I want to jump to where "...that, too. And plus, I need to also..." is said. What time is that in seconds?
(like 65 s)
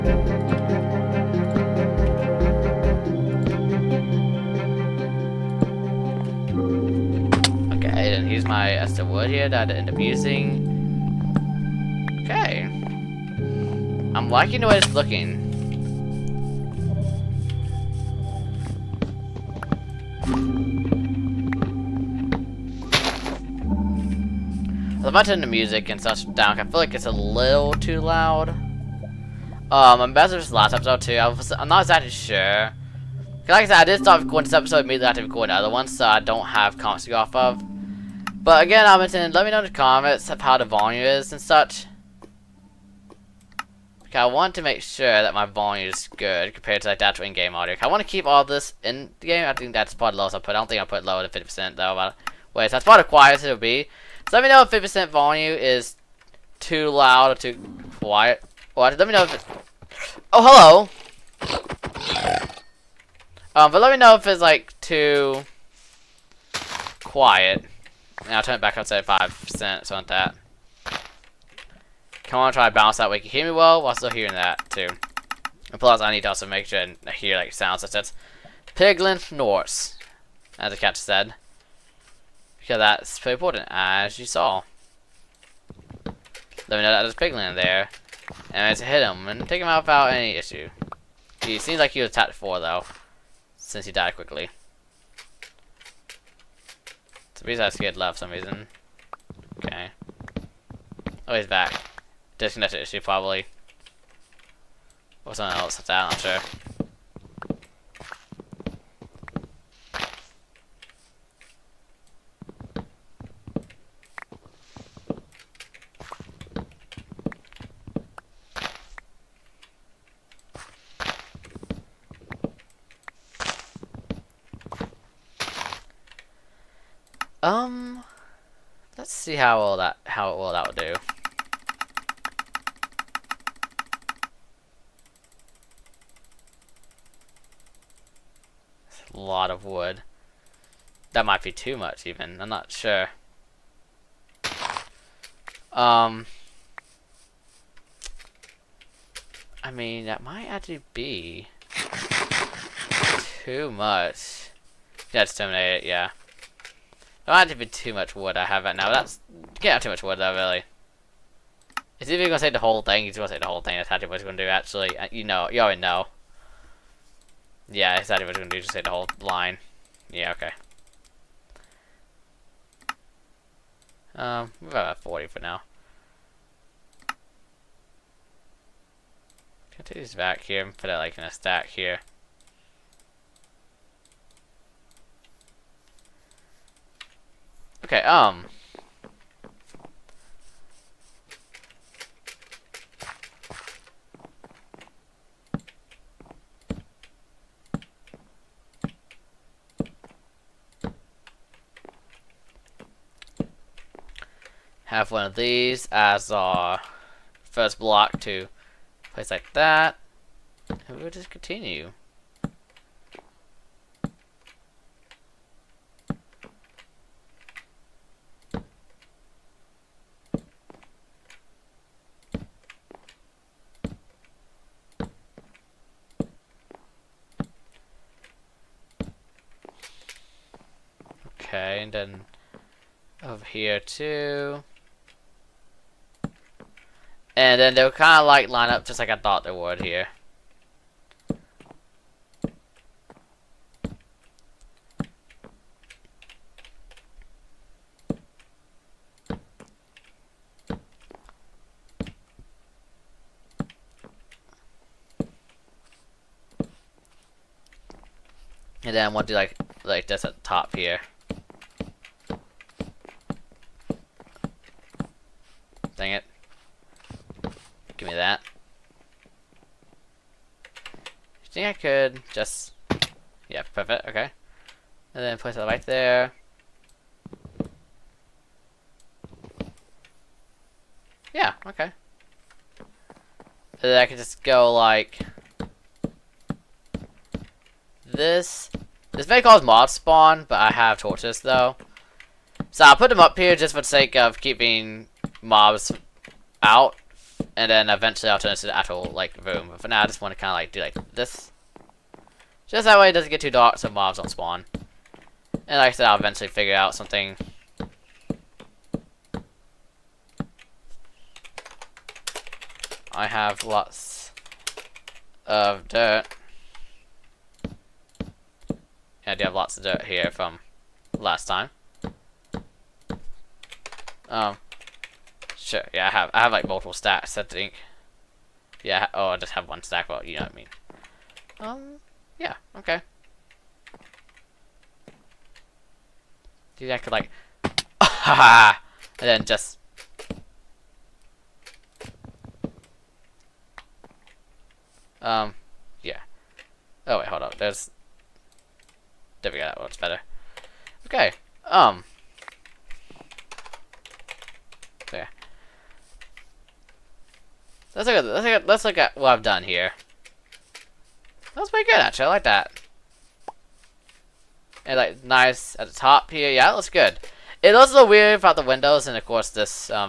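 74 s.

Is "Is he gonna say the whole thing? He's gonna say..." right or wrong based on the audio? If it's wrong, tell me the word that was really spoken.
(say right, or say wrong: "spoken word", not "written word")
right.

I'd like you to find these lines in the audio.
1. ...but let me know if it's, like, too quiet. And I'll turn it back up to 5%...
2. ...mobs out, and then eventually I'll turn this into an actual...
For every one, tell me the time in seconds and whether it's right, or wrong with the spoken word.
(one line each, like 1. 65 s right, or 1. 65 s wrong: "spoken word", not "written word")
1. 63 s right
2. 295 s right.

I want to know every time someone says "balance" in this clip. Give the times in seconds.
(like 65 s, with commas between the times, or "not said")
72 s.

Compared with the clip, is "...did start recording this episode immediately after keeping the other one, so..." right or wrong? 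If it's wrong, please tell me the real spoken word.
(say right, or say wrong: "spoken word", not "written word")
wrong: "recording", not "keeping".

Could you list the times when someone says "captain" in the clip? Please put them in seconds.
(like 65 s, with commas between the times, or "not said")
80 s.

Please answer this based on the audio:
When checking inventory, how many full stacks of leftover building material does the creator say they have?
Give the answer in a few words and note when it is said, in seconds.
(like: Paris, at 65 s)
one stack, at 329 s.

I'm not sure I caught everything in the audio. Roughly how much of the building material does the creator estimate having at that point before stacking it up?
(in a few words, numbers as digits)
about forty.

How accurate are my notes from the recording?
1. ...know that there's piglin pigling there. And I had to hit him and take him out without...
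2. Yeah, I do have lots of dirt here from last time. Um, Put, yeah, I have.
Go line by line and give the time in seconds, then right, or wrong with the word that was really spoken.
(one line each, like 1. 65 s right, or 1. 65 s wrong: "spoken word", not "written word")
1. 86 s right
2. 319 s wrong: "Sure", not "Put".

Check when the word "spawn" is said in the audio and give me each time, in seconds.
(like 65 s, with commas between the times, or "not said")
289 s, 304 s.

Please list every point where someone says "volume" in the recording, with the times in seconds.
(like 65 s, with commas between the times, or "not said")
40 s, 45 s, 55 s.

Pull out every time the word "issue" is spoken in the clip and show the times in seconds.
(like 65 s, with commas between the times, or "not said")
90 s, 102 s.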